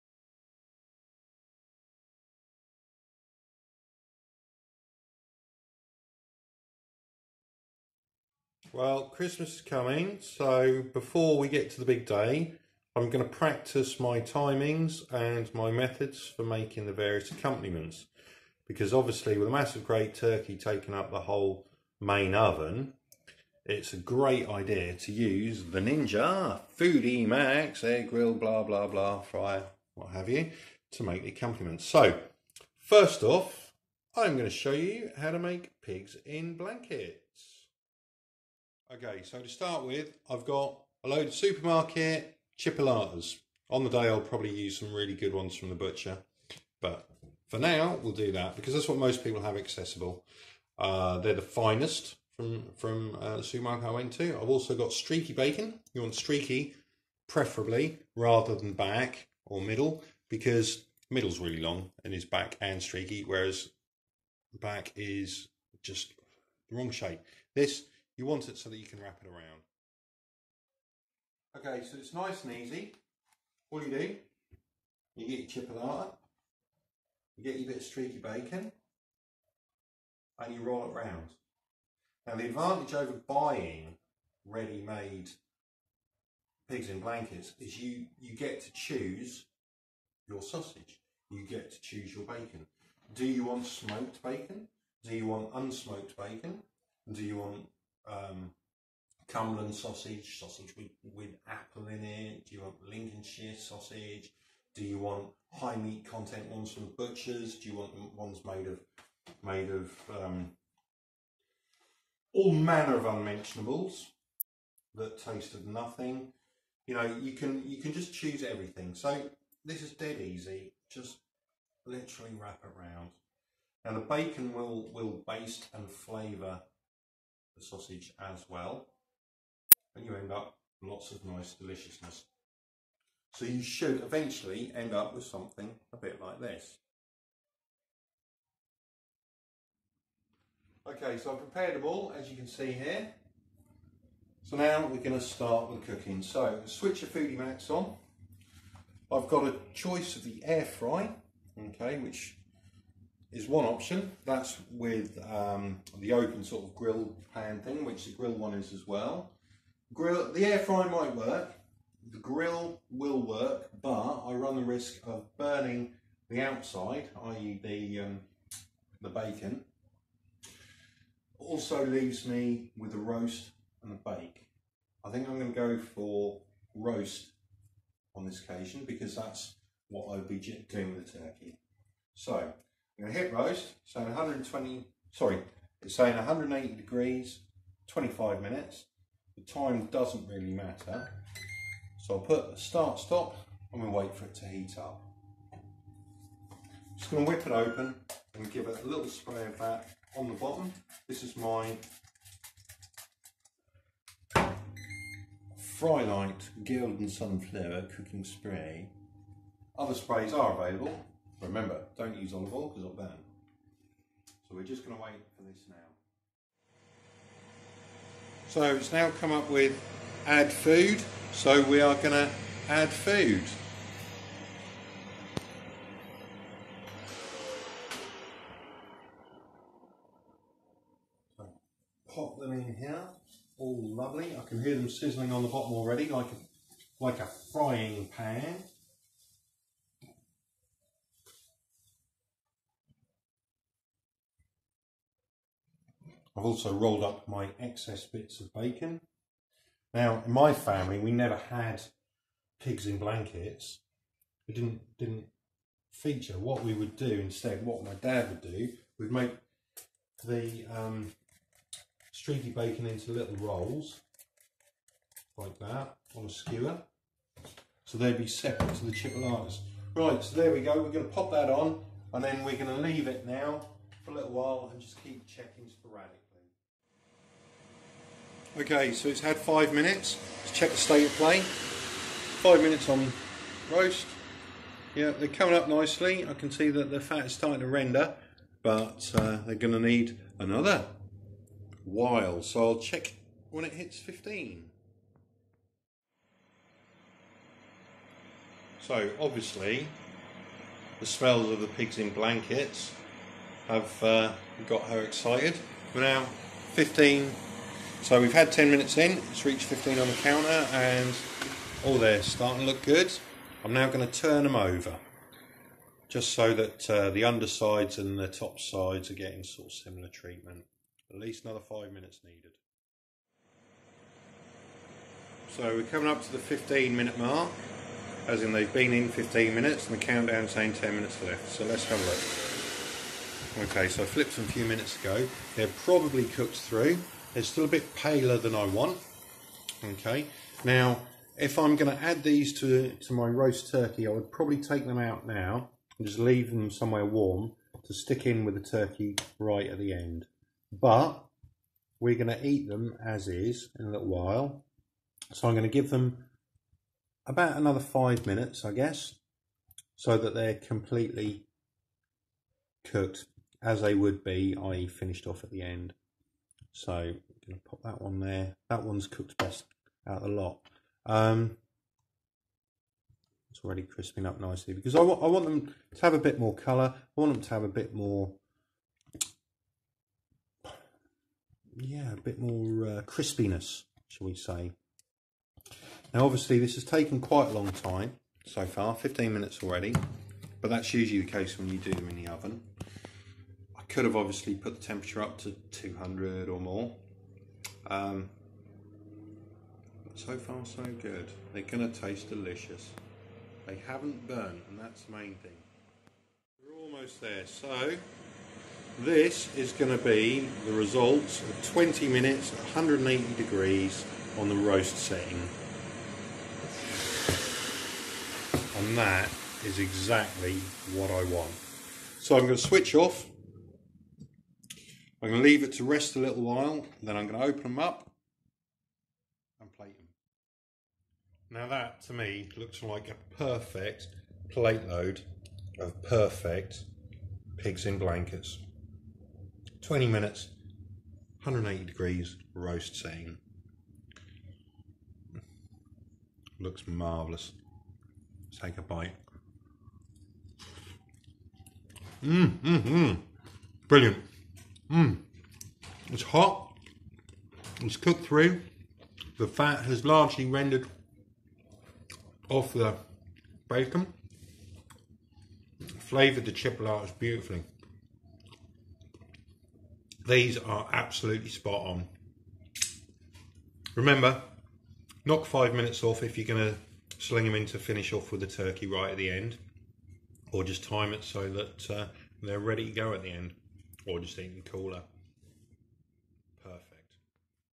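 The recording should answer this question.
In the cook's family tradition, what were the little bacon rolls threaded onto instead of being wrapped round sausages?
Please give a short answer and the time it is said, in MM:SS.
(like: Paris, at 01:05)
a skewer, at 04:26.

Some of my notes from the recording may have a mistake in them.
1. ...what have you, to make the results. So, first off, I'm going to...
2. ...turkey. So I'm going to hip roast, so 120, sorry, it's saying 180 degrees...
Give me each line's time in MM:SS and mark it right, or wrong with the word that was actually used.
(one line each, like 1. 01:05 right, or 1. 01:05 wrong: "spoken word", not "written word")
1. 00:29 wrong: "accompaniments", not "results"
2. 03:01 right.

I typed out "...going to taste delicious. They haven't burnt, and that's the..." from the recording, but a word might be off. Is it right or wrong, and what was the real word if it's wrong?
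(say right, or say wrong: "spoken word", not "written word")
right.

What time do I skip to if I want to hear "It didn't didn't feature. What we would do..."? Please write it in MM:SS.
04:14.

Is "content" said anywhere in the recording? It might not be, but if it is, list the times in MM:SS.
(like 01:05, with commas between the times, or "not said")
01:46.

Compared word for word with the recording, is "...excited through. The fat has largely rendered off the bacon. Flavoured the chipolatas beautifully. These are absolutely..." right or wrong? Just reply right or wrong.
wrong.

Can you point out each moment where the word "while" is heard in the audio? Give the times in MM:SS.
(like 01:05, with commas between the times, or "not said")
04:34, 04:51, 05:54, 07:06.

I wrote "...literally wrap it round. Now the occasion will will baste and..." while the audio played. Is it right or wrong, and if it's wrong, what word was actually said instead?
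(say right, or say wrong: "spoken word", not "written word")
wrong: "bacon", not "occasion".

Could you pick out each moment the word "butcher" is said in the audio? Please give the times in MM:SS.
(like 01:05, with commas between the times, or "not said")
00:45, 01:46.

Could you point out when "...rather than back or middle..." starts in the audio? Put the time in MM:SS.
00:58.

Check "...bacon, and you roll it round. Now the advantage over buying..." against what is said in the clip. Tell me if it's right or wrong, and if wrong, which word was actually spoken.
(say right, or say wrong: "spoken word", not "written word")
right.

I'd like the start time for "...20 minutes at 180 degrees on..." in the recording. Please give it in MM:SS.
06:51.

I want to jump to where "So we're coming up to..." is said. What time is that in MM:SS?
05:25.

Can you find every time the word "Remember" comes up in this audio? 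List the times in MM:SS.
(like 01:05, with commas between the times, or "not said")
03:31, 07:53.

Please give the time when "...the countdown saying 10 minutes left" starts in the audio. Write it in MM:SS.
05:30.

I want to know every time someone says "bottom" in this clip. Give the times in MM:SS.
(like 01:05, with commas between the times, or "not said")
03:20, 03:55.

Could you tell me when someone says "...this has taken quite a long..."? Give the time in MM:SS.
06:26.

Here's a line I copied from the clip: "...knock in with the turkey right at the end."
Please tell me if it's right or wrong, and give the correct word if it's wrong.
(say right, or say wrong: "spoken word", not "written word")
wrong: "stick", not "knock".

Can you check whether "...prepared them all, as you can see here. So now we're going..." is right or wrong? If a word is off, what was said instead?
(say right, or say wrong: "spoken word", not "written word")
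right.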